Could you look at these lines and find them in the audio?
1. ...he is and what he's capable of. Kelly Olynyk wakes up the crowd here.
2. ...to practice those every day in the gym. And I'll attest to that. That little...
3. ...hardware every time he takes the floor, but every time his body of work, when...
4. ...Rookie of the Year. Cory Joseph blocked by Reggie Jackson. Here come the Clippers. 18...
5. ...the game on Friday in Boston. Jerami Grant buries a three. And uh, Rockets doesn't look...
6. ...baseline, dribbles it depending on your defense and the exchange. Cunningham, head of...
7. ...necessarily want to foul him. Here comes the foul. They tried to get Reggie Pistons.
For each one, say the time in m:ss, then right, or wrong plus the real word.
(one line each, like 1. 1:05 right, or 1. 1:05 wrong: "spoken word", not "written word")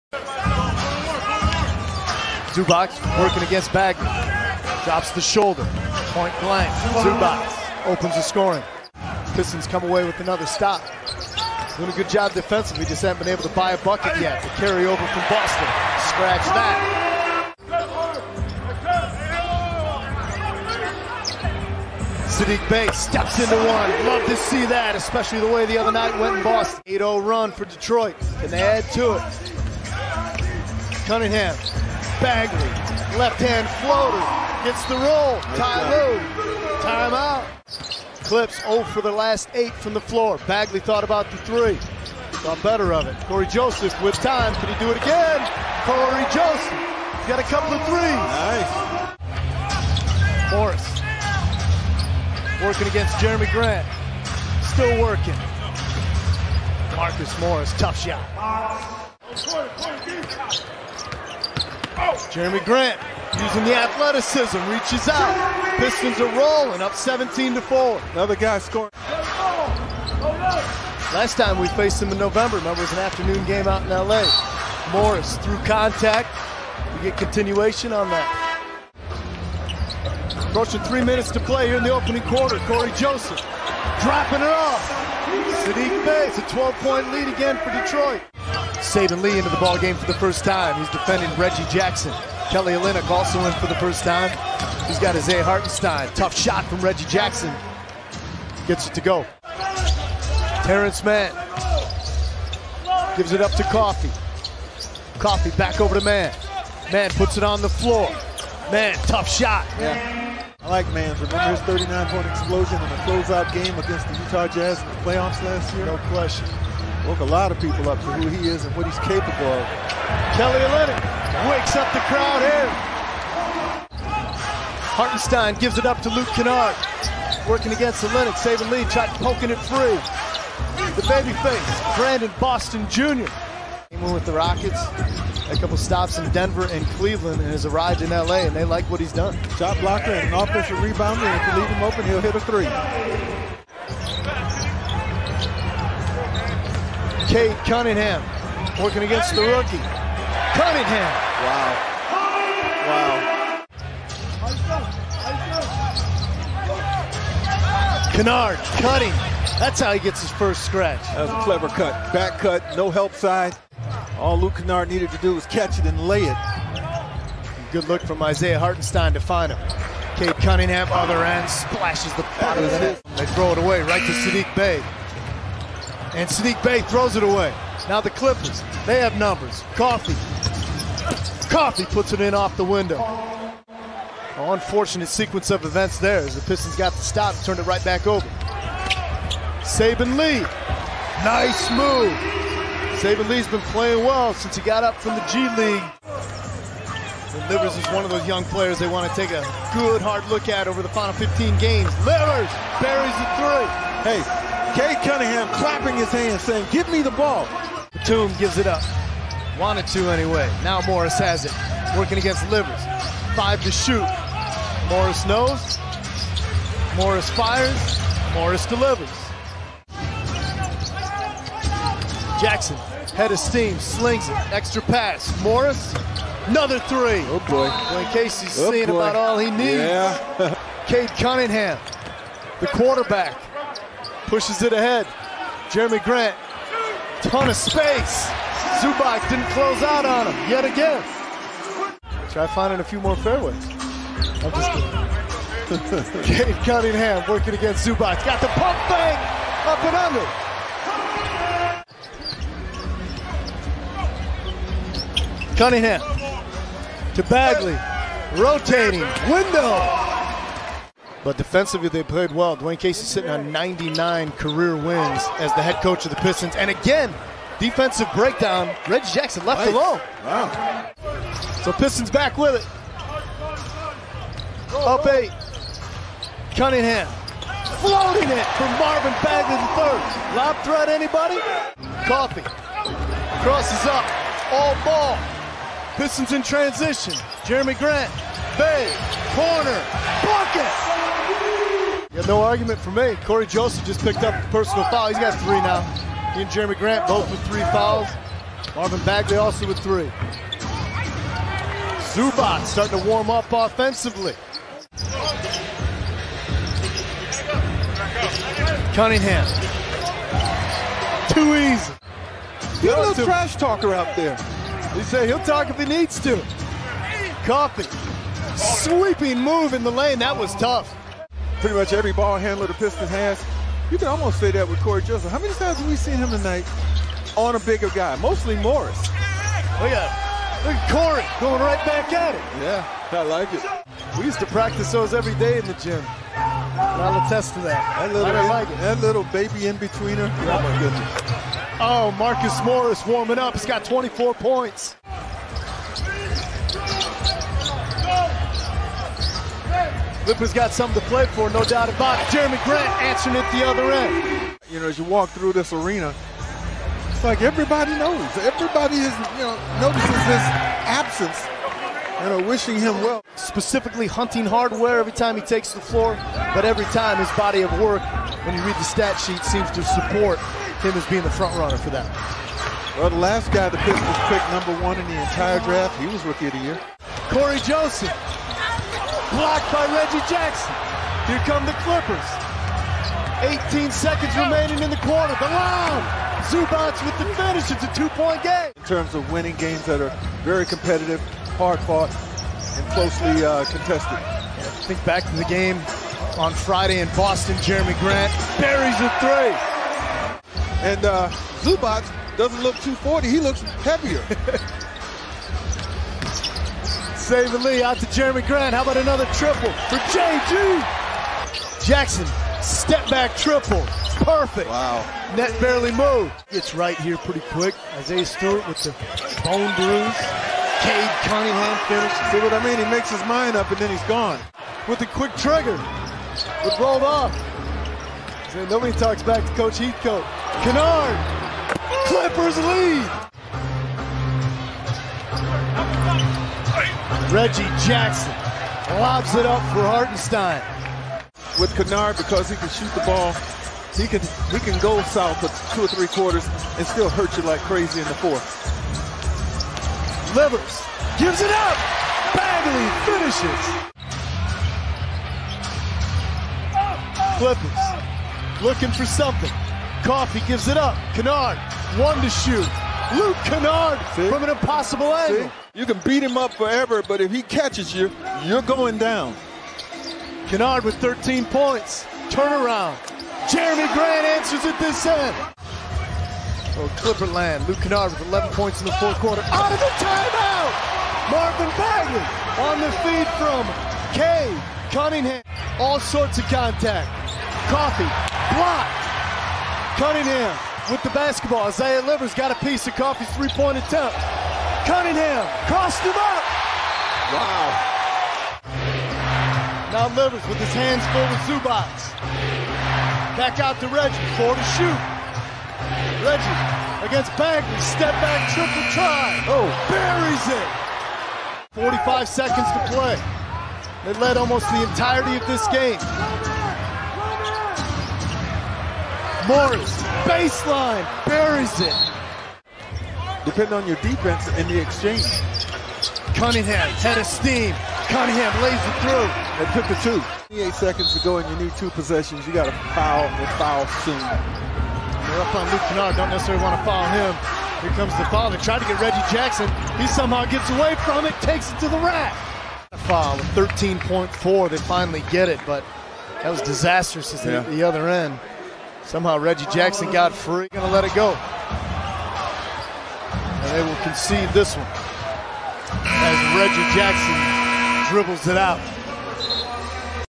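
1. 1:58 right
2. 5:34 right
3. 6:04 right
4. 6:16 right
5. 6:35 wrong: "Zubac", not "Rockets"
6. 8:40 wrong: "buries", not "dribbles"
7. 8:56 wrong: "Jackson", not "Pistons".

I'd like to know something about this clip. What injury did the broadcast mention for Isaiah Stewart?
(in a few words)
Bone bruise.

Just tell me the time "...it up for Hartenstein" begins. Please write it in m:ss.
7:19.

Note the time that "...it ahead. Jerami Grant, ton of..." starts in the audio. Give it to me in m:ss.
3:54.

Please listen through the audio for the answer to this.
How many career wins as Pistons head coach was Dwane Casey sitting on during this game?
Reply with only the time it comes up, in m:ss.
4:23.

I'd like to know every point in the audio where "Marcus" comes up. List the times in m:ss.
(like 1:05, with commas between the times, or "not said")
0:56, 5:42.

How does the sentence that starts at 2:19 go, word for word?
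Shot blocker and an offensive rebounder, and if you leave him open, he'll hit a three.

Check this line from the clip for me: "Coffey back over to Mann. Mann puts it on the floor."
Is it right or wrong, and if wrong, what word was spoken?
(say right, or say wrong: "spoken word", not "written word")
right.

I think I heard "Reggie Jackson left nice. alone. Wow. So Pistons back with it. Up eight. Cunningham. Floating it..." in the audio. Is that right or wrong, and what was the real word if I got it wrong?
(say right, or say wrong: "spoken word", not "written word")
right.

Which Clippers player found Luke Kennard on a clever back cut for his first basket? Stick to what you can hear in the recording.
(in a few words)
Isaiah Hartenstein.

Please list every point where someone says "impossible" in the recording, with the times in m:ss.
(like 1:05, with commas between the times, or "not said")
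7:44.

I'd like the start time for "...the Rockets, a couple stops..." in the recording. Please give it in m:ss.
2:14.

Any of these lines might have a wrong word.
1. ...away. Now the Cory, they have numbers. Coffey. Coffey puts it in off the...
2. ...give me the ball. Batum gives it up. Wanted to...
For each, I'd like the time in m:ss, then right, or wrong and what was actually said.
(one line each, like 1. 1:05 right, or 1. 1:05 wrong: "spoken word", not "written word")
1. 2:57 wrong: "Clippers", not "Cory"
2. 3:26 right.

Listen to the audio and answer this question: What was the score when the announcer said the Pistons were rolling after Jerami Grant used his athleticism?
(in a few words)
17 to 4.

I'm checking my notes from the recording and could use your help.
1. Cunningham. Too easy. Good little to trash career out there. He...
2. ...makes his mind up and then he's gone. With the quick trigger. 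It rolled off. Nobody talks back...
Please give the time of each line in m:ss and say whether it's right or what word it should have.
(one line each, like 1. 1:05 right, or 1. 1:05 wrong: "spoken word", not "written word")
1. 5:08 wrong: "talker", not "career"
2. 7:02 right.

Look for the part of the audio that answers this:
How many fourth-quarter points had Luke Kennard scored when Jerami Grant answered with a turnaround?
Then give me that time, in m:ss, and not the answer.
7:58.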